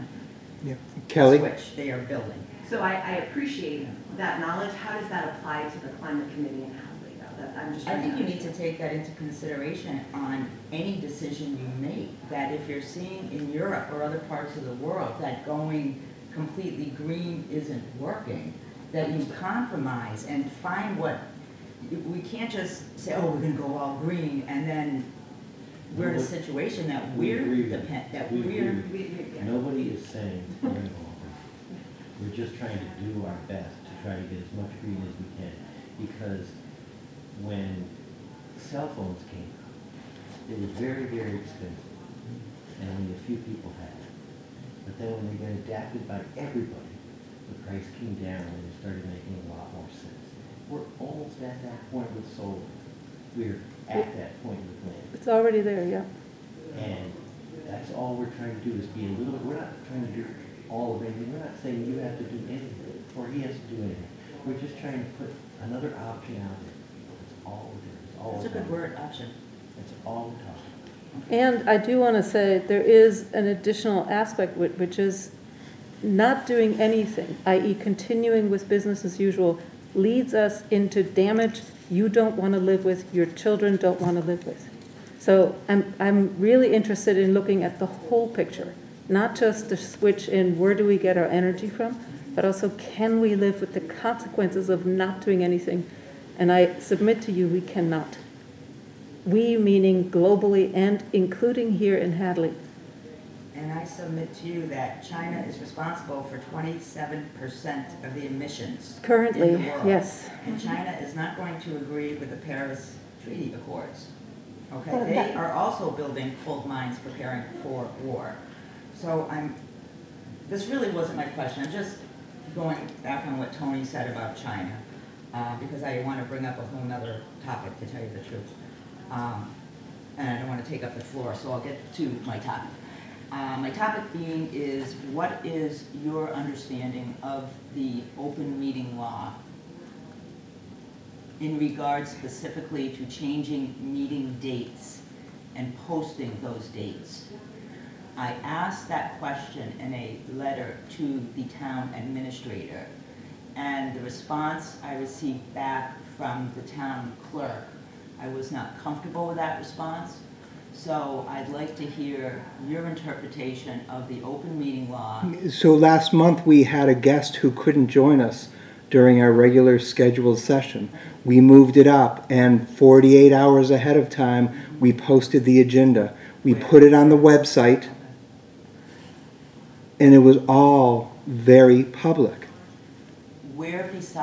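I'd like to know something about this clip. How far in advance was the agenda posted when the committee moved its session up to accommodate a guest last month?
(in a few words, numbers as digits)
48 hours.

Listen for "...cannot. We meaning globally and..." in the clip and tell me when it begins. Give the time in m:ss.
1:37.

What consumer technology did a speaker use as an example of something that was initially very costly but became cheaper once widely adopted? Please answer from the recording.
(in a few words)
cell phones.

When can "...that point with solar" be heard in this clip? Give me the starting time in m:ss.
0:51.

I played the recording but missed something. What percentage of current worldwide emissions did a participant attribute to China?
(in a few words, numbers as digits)
27%.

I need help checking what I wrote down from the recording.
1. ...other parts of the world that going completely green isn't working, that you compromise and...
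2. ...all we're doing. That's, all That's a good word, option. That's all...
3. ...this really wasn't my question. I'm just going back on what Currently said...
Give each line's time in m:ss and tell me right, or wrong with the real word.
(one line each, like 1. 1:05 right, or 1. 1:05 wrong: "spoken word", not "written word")
1. 0:14 right
2. 1:07 right
3. 2:00 wrong: "Tony", not "Currently".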